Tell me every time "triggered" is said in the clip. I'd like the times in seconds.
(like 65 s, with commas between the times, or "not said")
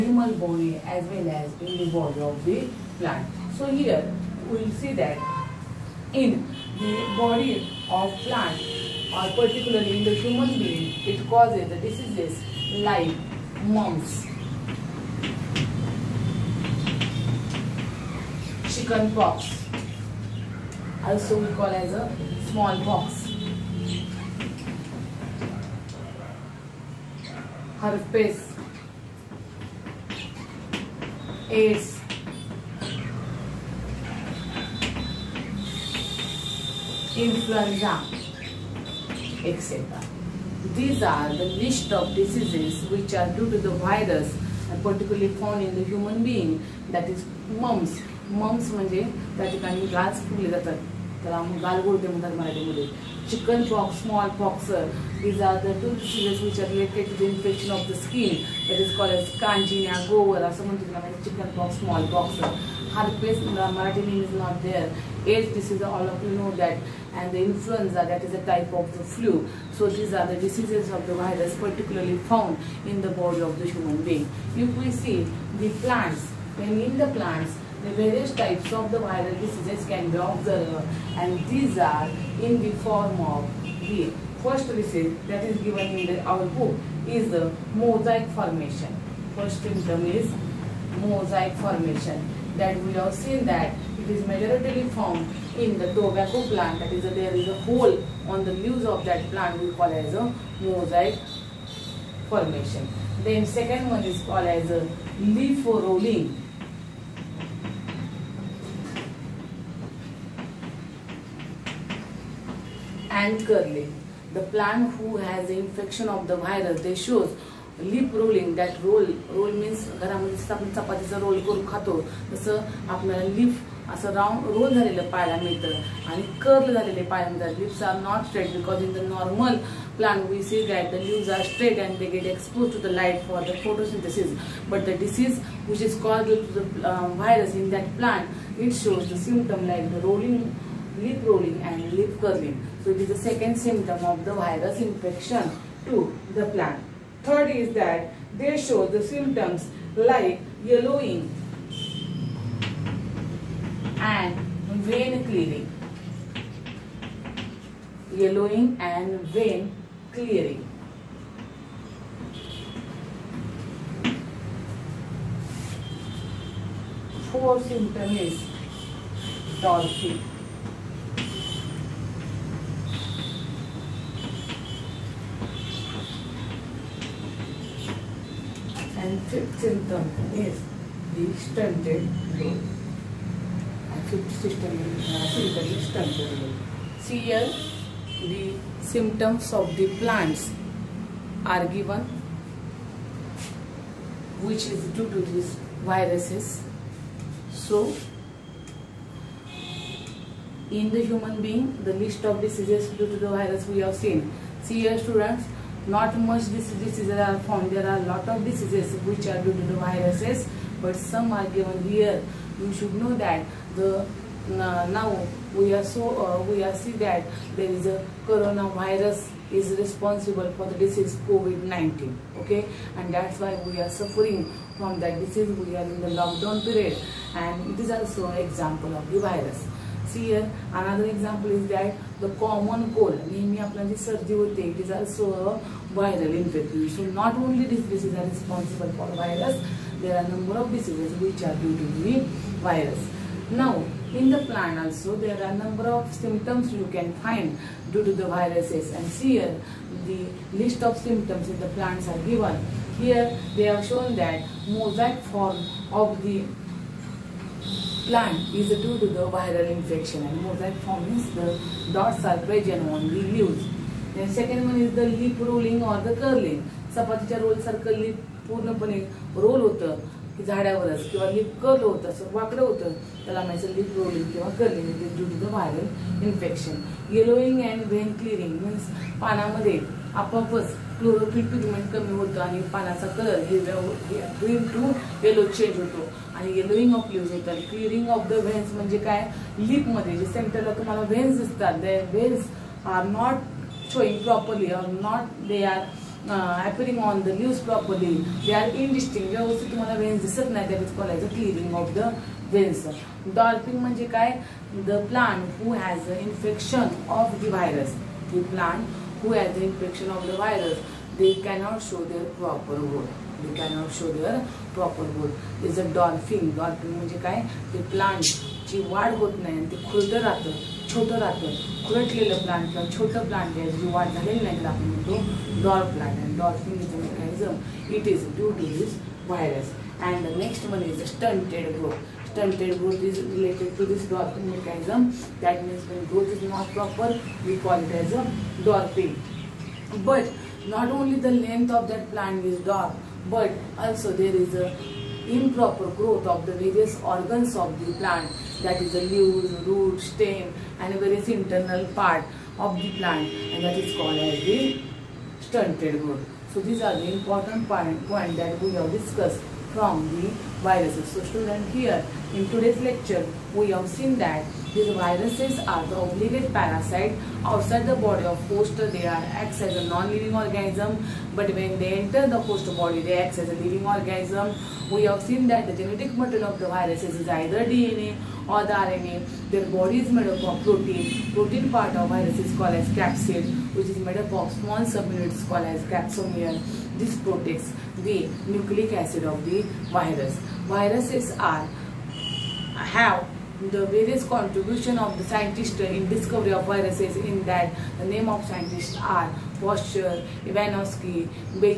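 not said.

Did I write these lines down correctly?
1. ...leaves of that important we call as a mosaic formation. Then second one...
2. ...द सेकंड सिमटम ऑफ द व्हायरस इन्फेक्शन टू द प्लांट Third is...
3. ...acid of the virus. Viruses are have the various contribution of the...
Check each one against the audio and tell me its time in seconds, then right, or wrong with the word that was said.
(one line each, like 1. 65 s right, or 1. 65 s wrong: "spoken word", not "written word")
1. 98 s wrong: "plant", not "important"
2. 143 s right
3. 388 s right.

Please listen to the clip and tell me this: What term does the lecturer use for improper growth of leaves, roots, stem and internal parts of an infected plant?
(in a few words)
Stunted growth.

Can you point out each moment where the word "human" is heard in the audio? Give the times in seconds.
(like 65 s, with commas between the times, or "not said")
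10 s, 45 s, 73 s, 201 s.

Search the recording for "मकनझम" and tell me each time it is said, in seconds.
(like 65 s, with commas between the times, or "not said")
326 s, 334 s.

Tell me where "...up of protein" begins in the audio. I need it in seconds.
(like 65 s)
380 s.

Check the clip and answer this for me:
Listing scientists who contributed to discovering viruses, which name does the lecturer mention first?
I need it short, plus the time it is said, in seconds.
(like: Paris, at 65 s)
Pasteur, at 399 s.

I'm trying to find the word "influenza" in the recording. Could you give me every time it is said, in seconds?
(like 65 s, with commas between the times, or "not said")
37 s, 67 s.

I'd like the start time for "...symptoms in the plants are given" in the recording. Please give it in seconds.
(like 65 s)
250 s.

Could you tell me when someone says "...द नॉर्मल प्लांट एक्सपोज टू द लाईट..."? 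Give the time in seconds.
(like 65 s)
128 s.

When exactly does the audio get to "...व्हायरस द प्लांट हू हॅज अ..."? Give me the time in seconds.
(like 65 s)
307 s.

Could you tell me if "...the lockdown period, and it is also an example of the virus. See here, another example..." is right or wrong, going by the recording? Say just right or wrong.
right.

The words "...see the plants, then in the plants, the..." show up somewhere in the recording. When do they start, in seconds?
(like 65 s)
74 s.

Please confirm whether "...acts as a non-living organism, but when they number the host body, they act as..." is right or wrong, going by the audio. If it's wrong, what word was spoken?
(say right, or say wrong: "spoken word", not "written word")
wrong: "enter", not "number".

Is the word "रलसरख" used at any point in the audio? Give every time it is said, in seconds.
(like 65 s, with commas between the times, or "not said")
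267 s.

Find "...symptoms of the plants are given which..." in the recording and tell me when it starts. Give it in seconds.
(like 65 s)
188 s.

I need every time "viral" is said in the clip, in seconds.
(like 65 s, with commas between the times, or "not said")
78 s, 235 s, 259 s.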